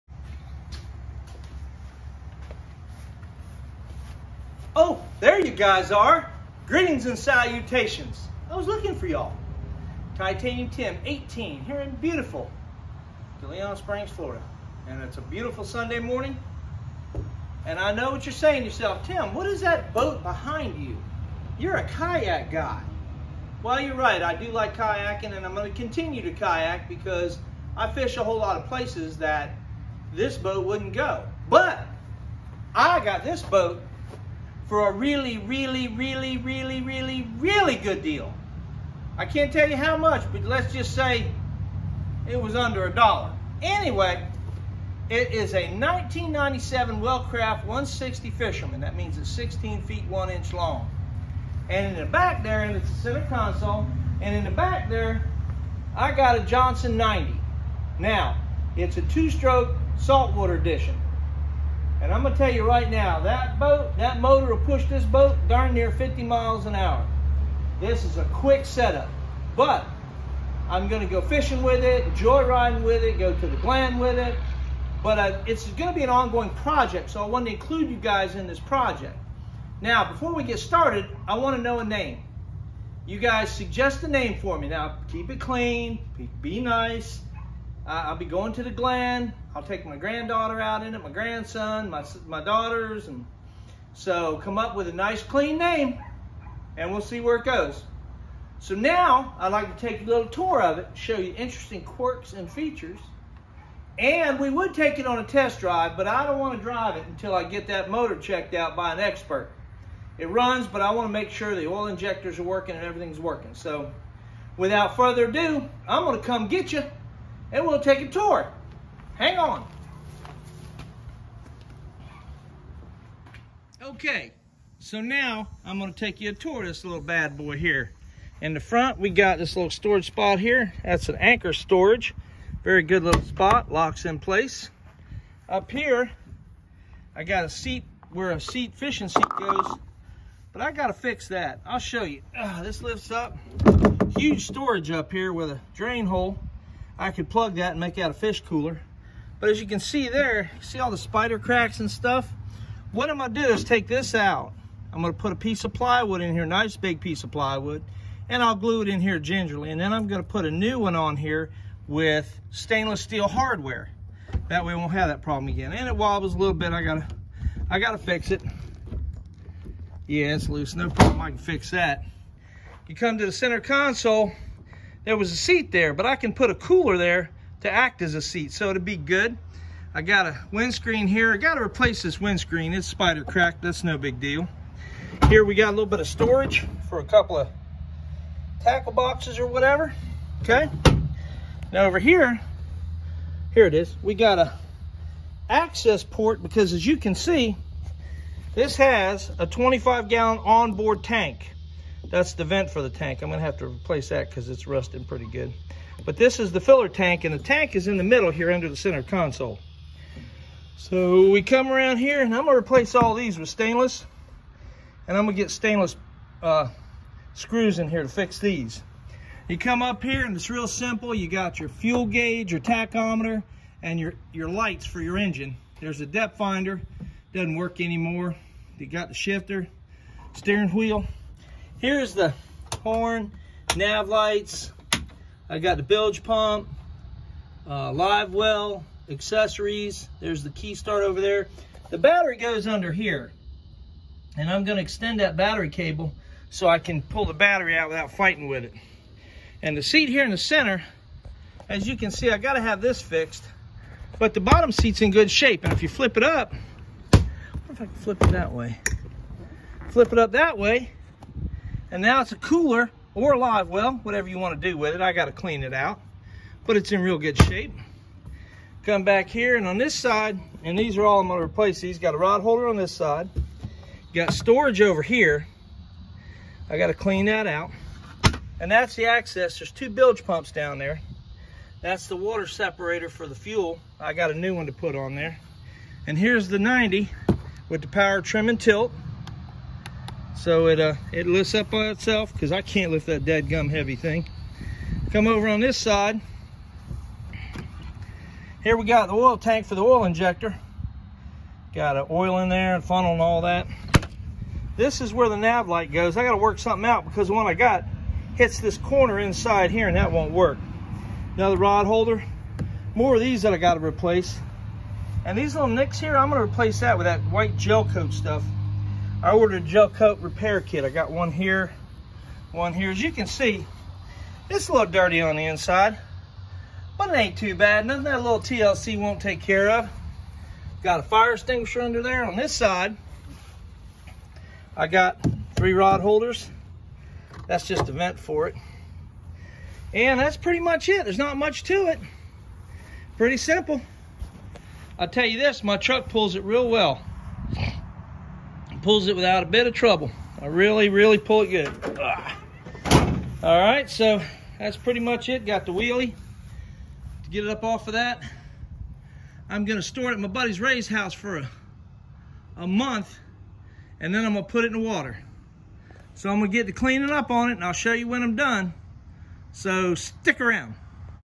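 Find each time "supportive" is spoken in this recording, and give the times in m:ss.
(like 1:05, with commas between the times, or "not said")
not said.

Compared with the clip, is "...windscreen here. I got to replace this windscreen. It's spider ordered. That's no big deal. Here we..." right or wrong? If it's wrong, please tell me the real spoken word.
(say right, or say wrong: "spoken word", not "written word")
wrong: "cracked", not "ordered".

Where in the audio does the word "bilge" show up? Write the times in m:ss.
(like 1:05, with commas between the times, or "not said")
3:55, 4:39.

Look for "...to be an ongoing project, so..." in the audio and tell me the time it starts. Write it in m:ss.
1:15.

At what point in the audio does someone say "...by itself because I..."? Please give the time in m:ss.
4:51.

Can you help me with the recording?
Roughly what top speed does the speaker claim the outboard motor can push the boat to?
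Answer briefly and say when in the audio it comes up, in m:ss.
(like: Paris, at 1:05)
50 miles an hour, at 1:05.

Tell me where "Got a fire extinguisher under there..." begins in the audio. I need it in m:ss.
5:30.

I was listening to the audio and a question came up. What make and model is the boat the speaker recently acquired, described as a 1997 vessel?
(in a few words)
Wellcraft 160 Fisherman.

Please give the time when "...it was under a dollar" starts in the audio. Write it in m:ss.
0:42.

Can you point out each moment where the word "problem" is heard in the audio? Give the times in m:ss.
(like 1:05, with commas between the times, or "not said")
2:45, 2:50.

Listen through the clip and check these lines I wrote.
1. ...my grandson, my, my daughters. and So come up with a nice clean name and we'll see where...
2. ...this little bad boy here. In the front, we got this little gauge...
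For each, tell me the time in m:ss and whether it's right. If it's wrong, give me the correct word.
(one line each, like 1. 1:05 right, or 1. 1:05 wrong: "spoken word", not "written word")
1. 1:31 right
2. 2:06 wrong: "storage", not "gauge".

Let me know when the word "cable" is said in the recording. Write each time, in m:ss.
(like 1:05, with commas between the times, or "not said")
4:05.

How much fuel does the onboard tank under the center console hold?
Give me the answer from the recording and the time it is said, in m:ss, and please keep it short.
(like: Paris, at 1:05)
25 gallons, at 3:19.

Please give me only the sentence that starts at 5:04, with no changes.
This is where the nav light goes.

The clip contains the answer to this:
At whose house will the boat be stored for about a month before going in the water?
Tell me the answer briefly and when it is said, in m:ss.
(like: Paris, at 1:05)
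Ray's, at 6:00.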